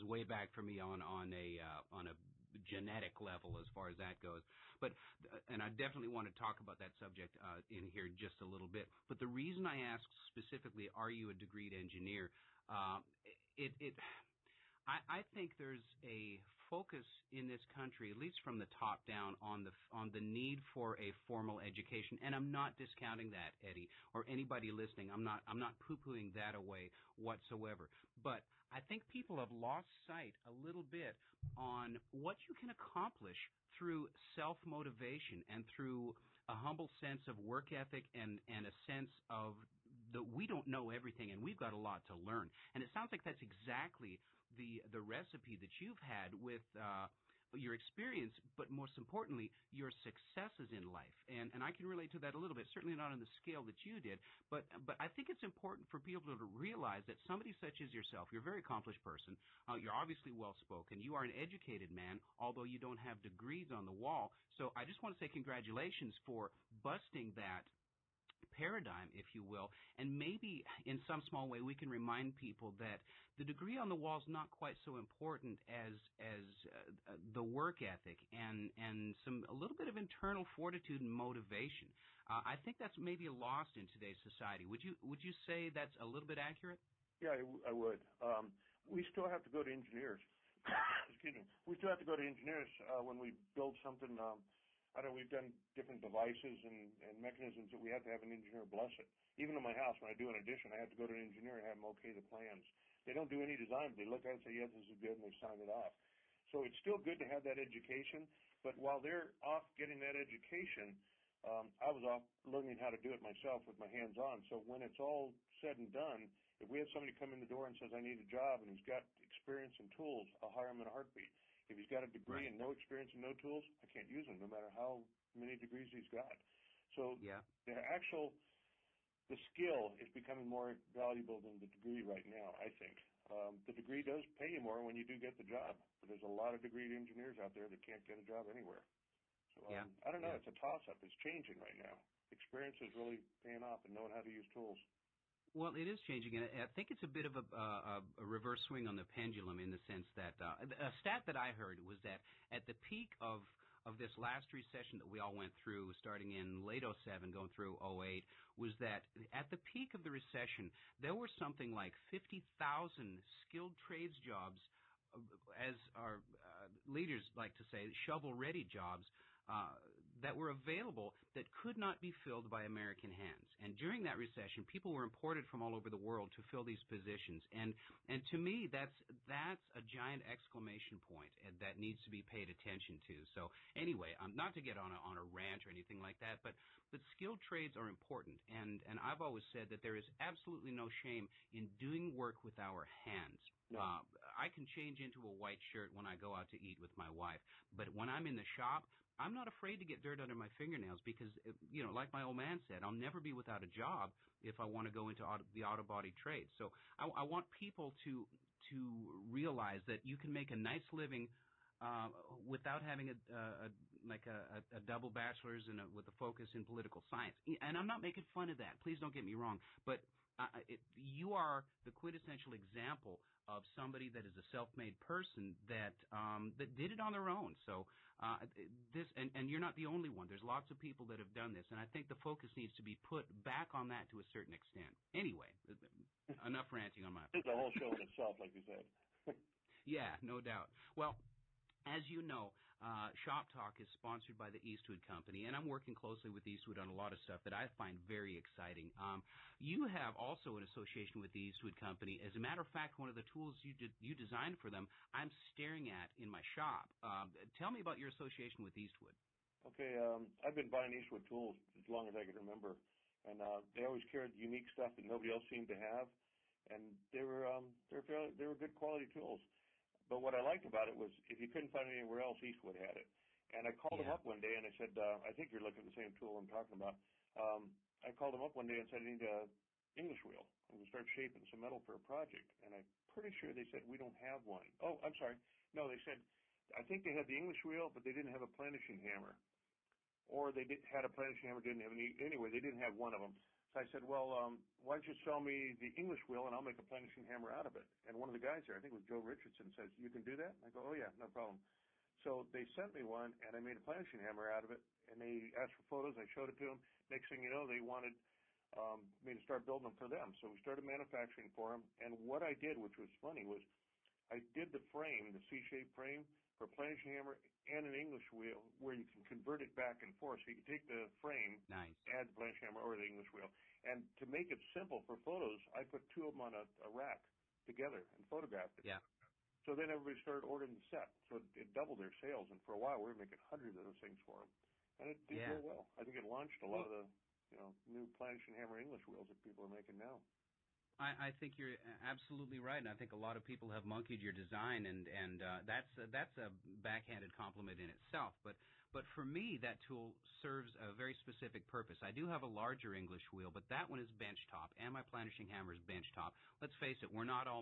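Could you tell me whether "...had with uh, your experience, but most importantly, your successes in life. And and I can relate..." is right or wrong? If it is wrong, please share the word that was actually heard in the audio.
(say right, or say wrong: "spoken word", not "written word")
right.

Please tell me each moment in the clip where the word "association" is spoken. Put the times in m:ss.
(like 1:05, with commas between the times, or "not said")
4:10, 4:18.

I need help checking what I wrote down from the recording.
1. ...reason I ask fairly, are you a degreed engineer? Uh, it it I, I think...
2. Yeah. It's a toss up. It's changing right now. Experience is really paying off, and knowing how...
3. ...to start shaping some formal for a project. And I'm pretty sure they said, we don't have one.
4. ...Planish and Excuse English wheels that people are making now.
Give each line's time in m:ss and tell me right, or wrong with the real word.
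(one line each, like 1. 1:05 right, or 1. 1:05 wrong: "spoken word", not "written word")
1. 0:09 wrong: "specifically", not "fairly"
2. 2:20 right
3. 4:40 wrong: "metal", not "formal"
4. 5:38 wrong: "Hammer", not "Excuse".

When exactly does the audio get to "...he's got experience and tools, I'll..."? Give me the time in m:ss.
1:58.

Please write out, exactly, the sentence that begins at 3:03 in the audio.
So anyway, um, not to get on a, on a rant or anything like that, but but skilled trades are important.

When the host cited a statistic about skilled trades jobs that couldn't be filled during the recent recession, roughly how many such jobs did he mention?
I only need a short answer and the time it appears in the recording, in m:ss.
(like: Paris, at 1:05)
50,000, at 2:42.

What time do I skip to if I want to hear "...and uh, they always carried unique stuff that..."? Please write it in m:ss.
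4:23.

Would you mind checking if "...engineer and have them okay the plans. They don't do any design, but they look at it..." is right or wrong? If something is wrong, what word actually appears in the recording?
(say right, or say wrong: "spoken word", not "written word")
right.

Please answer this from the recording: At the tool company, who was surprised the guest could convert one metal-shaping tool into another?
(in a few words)
Joe Richardson.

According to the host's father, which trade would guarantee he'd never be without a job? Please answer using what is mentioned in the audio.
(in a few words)
auto body.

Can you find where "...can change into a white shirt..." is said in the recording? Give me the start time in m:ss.
3:14.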